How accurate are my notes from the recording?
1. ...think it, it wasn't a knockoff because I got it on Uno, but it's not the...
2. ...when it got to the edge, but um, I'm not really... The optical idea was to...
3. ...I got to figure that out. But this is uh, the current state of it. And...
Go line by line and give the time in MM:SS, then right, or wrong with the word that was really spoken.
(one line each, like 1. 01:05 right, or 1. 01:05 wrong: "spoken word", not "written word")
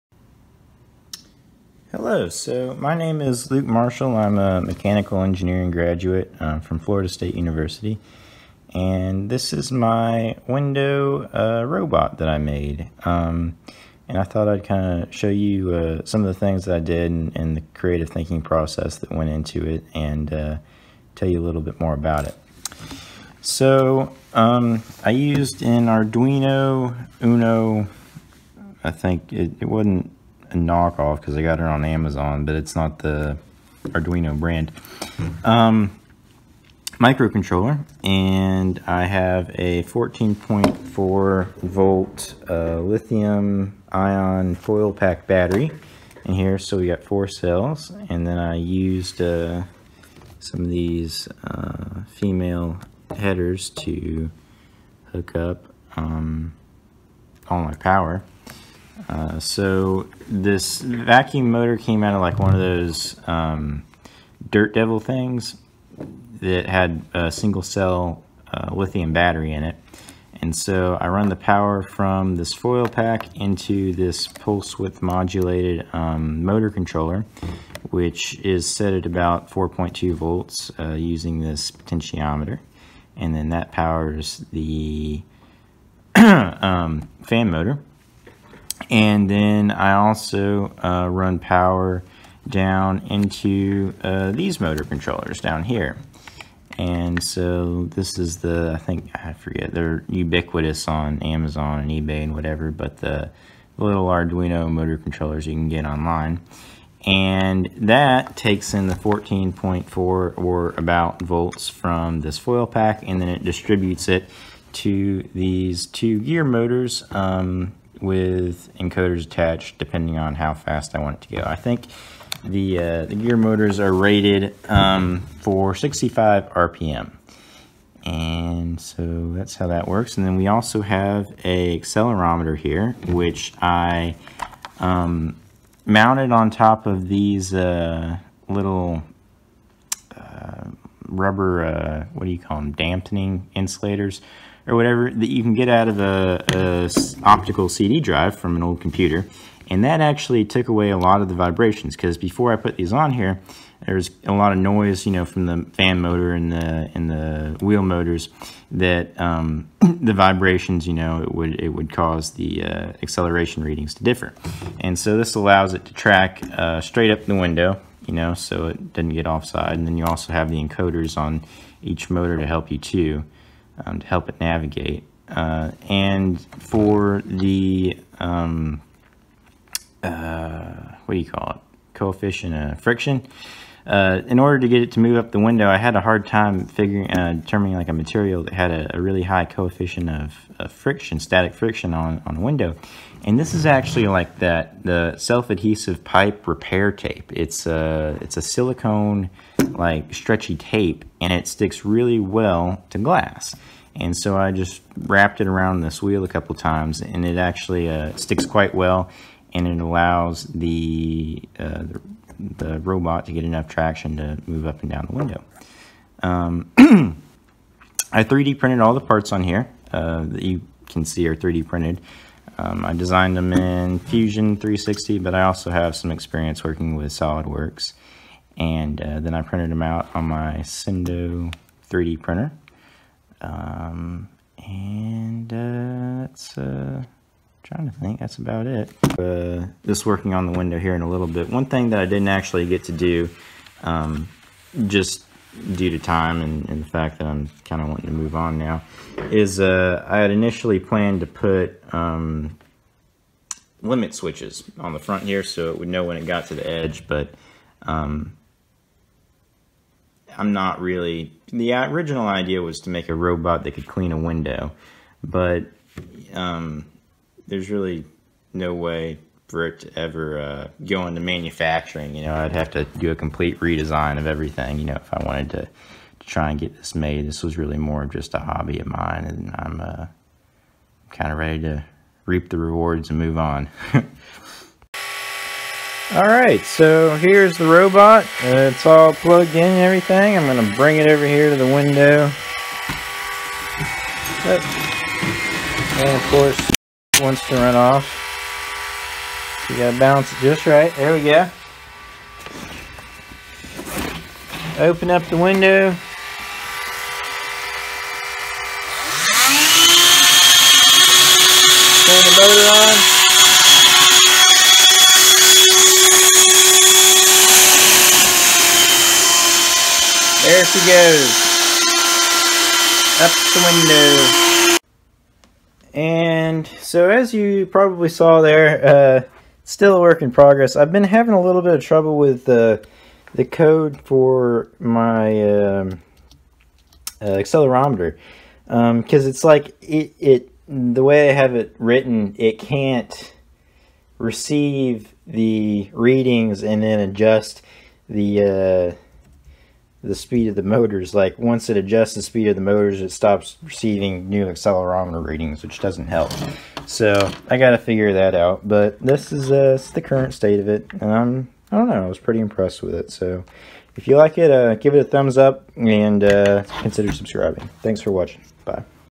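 1. 00:28 wrong: "Amazon", not "Uno"
2. 04:16 wrong: "original", not "optical"
3. 05:57 right.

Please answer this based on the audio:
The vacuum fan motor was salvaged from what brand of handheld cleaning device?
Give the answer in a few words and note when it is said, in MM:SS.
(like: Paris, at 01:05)
Dirt Devil, at 01:04.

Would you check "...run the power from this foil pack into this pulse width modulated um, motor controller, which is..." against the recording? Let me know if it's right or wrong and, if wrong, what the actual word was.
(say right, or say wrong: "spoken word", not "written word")
right.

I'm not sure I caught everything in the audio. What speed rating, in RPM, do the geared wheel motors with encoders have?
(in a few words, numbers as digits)
65 RPM.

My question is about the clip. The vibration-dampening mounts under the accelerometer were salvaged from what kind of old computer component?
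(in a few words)
optical CD drive.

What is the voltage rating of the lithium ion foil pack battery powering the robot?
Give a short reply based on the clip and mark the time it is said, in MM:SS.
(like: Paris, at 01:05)
14.4 volts, at 00:39.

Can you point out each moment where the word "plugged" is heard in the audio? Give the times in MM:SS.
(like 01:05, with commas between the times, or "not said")
04:49.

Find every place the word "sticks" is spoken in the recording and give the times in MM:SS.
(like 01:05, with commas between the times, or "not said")
03:21, 03:28.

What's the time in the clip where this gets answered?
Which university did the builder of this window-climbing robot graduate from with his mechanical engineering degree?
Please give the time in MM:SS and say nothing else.
00:06.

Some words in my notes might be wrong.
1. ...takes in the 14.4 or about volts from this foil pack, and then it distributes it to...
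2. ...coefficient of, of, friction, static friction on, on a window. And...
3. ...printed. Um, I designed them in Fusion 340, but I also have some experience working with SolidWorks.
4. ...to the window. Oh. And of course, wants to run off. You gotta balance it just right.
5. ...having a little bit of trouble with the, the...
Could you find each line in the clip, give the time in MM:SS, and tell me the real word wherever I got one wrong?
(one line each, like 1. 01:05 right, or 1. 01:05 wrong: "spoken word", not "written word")
1. 01:48 right
2. 03:09 right
3. 03:41 wrong: "360", not "340"
4. 04:51 right
5. 05:31 right.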